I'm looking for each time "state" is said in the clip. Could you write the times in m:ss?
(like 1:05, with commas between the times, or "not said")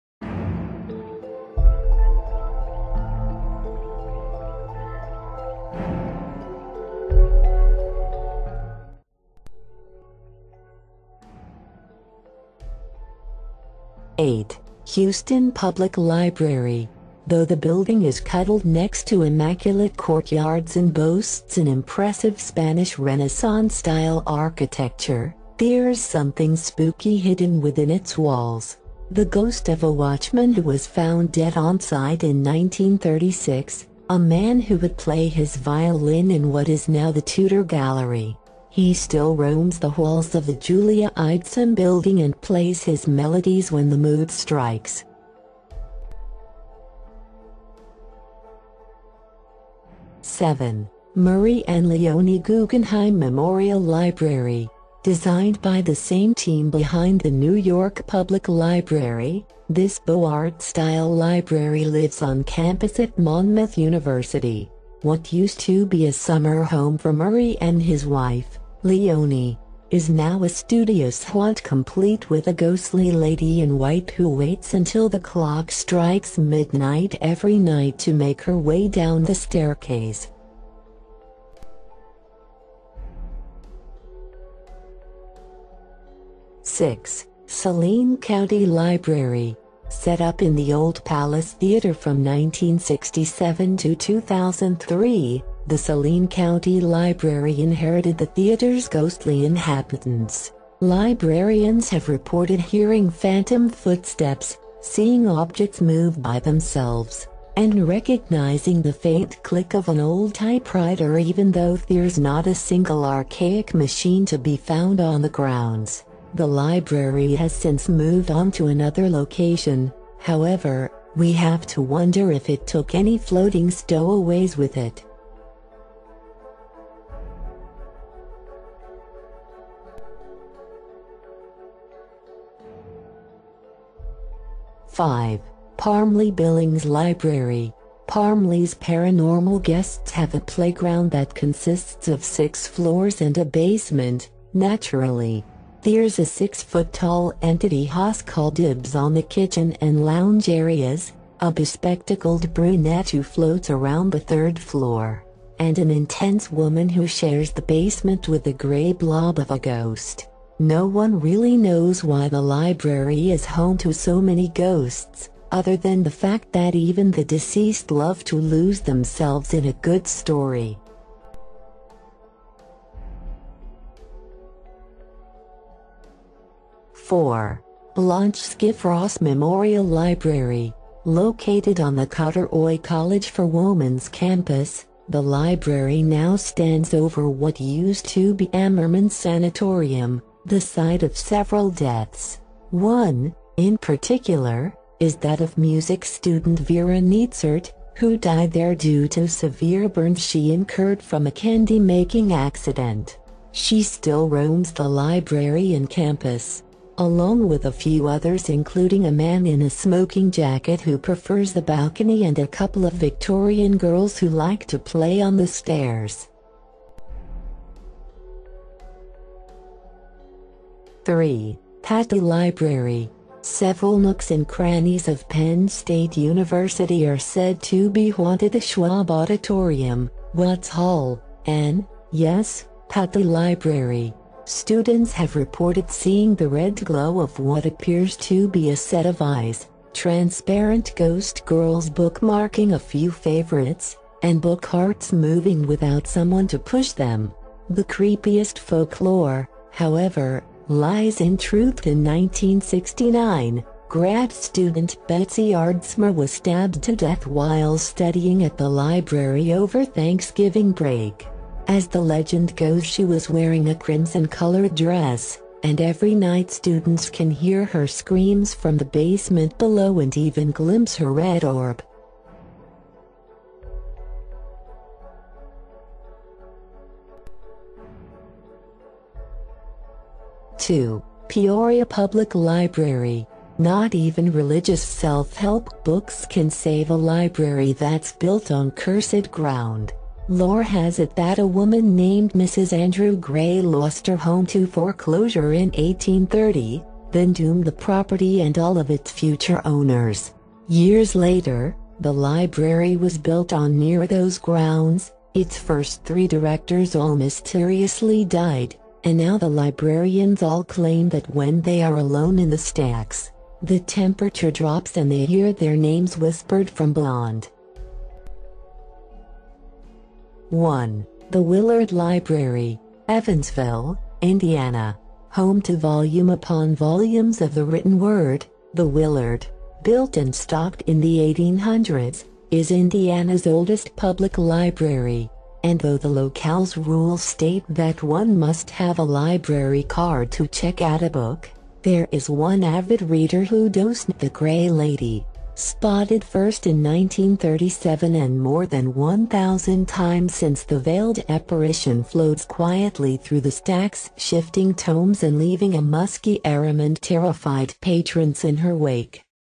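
3:45, 5:37.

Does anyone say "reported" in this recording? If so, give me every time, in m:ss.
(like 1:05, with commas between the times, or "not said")
1:42, 3:55.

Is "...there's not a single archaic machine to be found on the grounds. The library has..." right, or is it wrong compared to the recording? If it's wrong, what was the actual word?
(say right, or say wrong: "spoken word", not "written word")
right.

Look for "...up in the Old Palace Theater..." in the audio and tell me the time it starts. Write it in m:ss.
1:30.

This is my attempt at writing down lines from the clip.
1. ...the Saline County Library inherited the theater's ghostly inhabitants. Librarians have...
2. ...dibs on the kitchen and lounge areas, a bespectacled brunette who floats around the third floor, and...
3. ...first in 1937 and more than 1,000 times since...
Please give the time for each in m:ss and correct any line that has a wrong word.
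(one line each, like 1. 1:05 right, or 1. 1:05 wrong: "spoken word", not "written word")
1. 1:35 right
2. 2:28 right
3. 5:46 right.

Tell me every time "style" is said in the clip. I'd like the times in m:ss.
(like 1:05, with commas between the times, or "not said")
0:22, 1:00.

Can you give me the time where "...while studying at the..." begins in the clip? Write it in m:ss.
4:17.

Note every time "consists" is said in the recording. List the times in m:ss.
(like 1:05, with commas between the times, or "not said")
2:21.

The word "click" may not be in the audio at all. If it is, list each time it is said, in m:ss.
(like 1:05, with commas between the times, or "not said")
1:49.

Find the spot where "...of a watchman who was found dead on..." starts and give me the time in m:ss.
0:29.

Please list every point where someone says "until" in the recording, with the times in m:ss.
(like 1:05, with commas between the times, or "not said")
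1:14.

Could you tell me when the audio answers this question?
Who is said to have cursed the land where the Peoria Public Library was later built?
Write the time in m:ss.
4:52.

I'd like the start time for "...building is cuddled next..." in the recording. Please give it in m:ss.
0:17.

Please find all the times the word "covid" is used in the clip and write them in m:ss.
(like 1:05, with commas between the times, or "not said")
not said.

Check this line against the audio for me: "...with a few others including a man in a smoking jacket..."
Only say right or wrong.
right.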